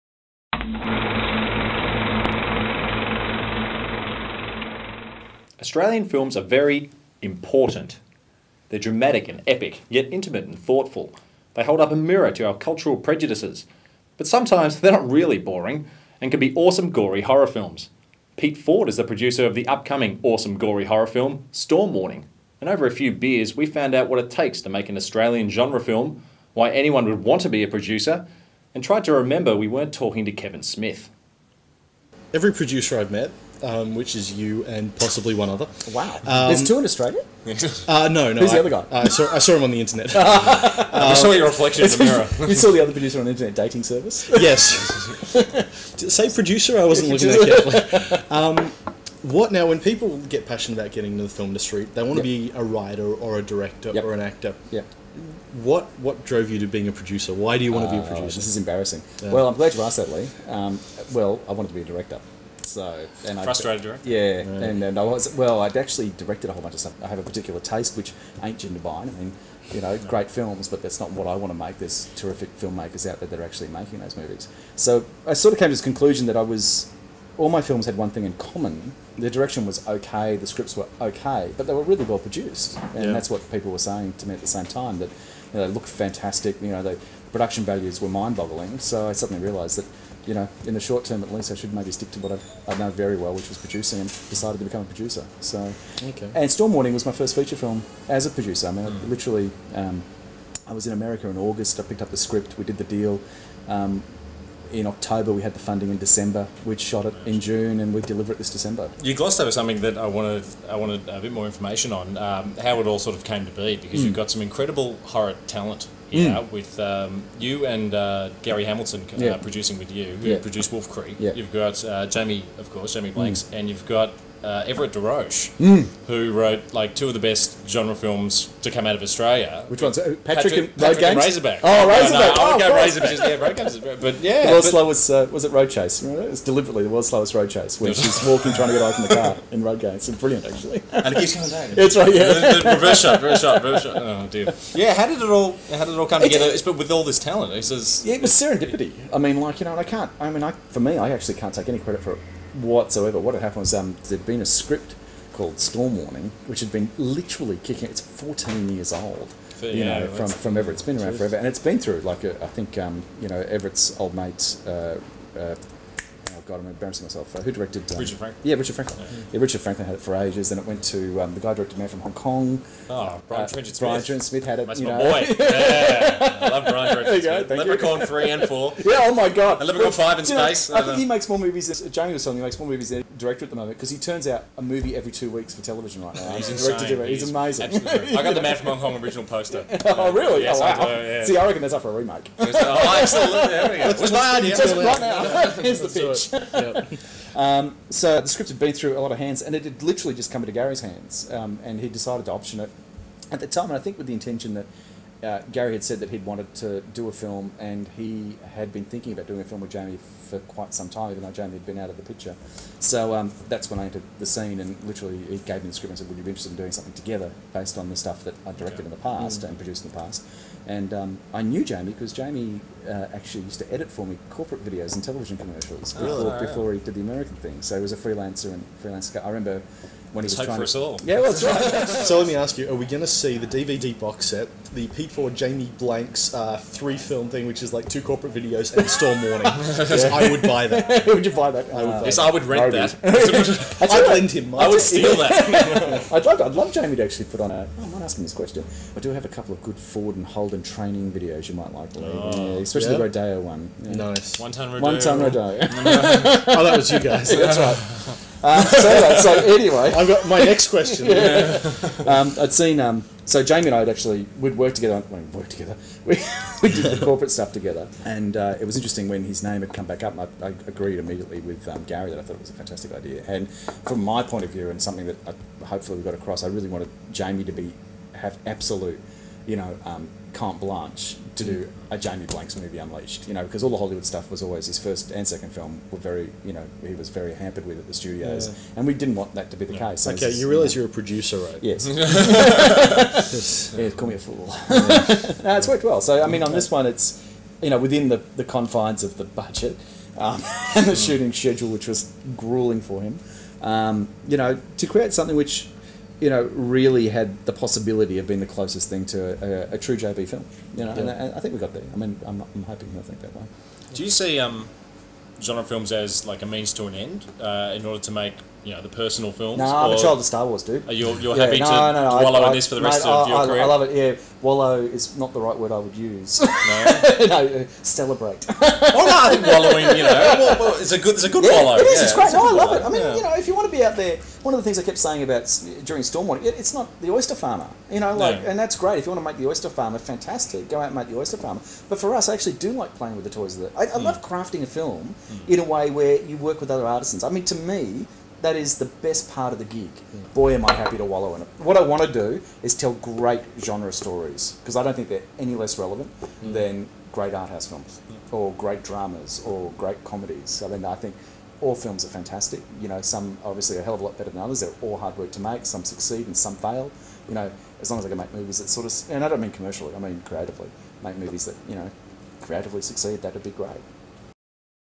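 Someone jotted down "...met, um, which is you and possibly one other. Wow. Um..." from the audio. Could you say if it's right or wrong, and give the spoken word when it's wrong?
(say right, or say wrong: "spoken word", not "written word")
right.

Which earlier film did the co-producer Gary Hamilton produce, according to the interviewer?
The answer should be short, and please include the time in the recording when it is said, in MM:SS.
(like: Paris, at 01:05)
Wolf Creek, at 02:00.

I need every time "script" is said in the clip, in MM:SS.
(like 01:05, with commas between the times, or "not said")
01:20, 01:42, 02:34, 03:18, 03:35.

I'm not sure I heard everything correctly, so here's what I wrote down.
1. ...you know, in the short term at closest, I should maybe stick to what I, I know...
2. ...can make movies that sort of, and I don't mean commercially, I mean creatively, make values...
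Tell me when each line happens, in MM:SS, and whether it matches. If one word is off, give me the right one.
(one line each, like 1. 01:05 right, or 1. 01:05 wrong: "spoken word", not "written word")
1. 01:30 wrong: "least", not "closest"
2. 06:08 wrong: "movies", not "values".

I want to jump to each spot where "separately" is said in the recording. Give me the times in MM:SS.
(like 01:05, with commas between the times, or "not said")
not said.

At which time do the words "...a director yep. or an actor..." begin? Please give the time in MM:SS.
00:53.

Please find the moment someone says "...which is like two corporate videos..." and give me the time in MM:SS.
03:57.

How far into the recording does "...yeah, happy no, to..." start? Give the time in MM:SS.
05:21.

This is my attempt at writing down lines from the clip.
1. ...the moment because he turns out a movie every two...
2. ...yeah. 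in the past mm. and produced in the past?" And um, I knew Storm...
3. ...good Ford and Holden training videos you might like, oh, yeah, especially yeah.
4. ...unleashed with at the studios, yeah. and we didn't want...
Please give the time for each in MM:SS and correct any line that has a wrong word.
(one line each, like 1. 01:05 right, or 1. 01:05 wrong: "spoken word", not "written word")
1. 03:03 right
2. 03:38 wrong: "Jamie", not "Storm"
3. 04:09 right
4. 04:47 wrong: "hampered", not "unleashed".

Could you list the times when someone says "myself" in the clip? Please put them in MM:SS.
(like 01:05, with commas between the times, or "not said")
02:47.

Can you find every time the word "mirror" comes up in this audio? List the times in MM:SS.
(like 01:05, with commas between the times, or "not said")
00:11, 00:42.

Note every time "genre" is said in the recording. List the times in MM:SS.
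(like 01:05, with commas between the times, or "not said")
00:25, 02:07, 05:15, 05:53.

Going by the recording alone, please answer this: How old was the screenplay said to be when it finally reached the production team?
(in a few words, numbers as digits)
14 years.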